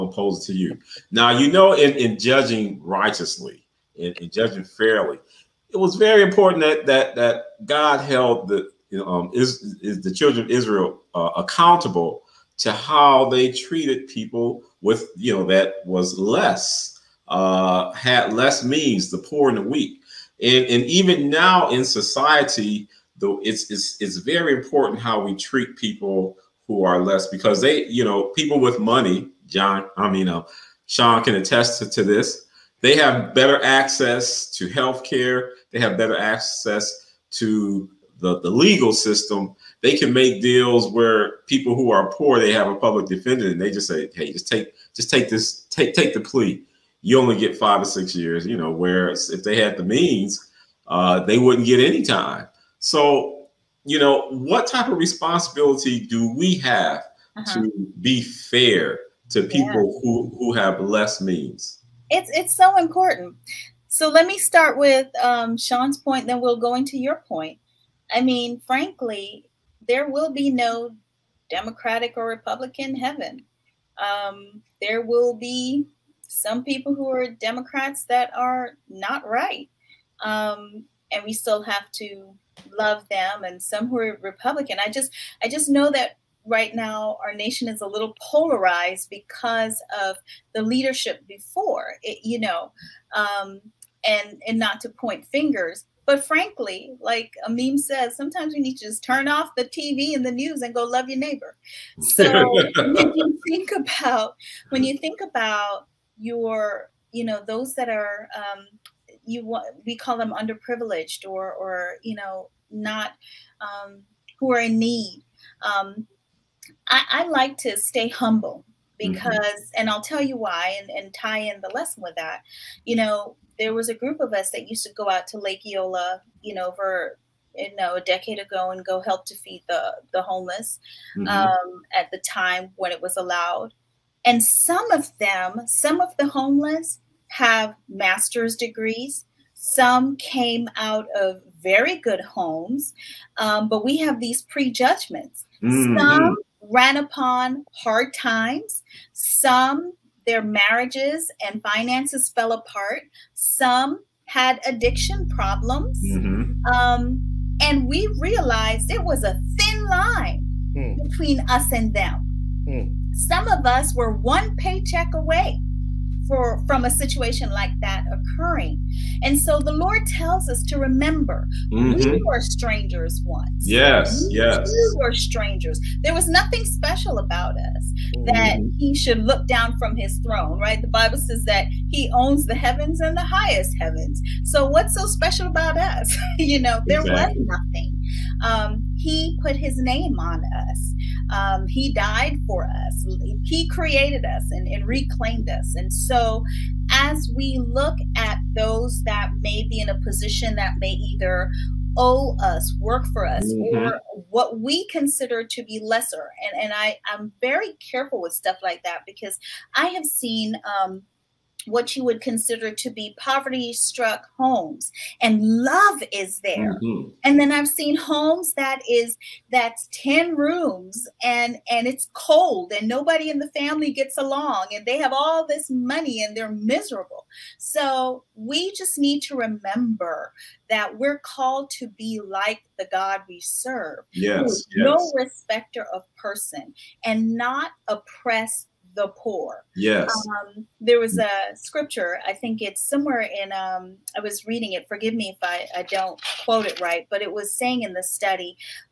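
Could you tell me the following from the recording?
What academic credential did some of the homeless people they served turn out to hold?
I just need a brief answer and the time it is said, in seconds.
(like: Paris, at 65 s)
Master's degrees, at 137 s.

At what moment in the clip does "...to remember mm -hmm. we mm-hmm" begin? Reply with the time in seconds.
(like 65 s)
170 s.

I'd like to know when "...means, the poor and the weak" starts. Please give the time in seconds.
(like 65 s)
18 s.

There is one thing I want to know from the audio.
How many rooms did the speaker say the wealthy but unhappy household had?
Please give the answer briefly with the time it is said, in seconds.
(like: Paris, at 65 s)
10, at 219 s.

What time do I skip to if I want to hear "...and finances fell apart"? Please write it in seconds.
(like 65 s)
151 s.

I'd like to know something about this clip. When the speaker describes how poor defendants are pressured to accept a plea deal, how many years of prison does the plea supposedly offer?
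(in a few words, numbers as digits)
5 or 6 years.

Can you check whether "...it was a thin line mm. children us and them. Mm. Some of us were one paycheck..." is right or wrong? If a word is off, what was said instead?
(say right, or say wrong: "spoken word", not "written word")
wrong: "between", not "children".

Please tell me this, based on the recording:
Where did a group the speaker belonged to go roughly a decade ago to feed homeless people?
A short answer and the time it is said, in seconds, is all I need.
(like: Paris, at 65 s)
Lake Eola, at 125 s.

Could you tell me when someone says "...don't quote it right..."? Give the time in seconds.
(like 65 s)
245 s.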